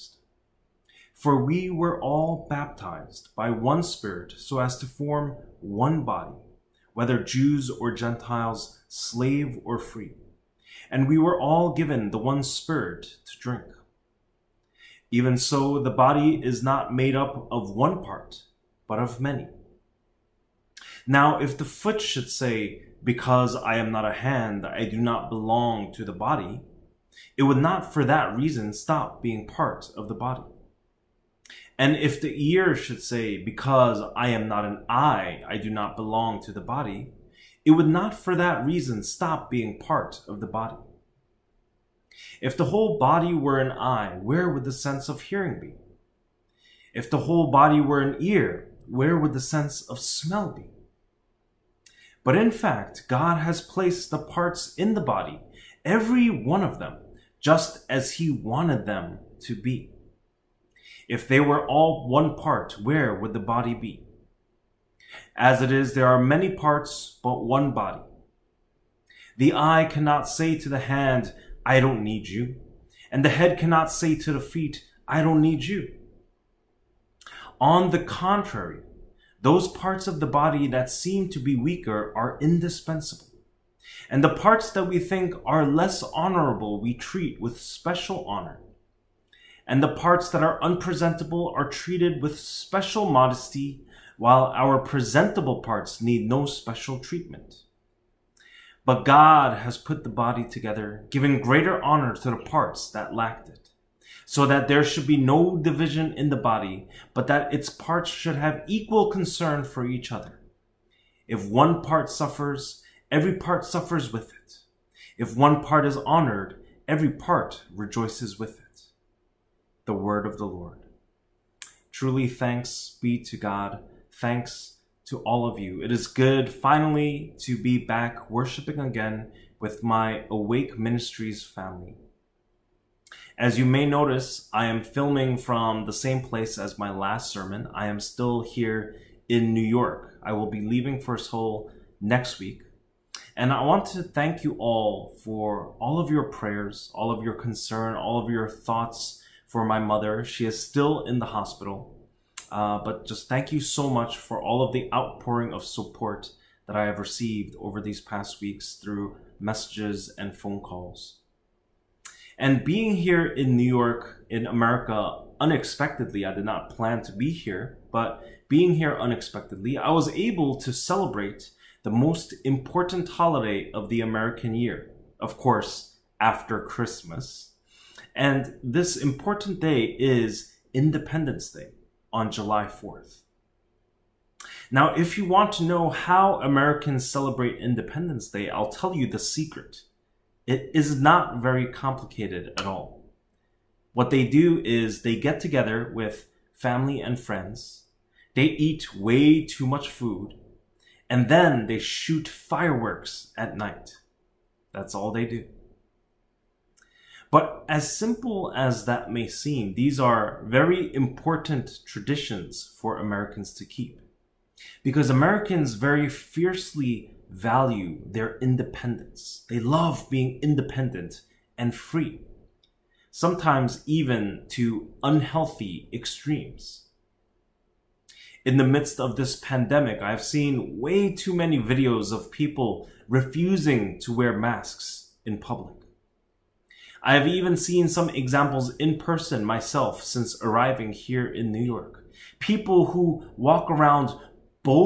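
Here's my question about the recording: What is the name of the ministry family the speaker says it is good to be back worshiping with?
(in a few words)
Awake Ministries.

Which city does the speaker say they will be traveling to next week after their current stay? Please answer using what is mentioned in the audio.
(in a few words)
Seoul.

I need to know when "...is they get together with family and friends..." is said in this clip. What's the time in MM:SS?
03:14.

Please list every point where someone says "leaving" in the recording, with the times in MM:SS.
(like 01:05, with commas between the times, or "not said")
02:20.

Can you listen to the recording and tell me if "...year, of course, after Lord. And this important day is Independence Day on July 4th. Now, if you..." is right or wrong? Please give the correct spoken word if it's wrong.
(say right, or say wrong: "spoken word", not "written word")
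wrong: "Christmas", not "Lord".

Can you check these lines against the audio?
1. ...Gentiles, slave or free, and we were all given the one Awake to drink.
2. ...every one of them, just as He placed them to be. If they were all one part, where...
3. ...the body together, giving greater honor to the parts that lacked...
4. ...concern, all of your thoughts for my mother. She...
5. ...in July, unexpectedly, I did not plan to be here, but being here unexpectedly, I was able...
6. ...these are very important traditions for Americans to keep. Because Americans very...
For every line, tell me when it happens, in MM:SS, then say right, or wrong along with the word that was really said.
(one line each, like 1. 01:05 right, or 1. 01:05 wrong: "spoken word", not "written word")
1. 00:07 wrong: "Spirit", not "Awake"
2. 00:55 wrong: "wanted", not "placed"
3. 01:40 right
4. 02:27 right
5. 02:44 wrong: "America", not "July"
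6. 03:29 right.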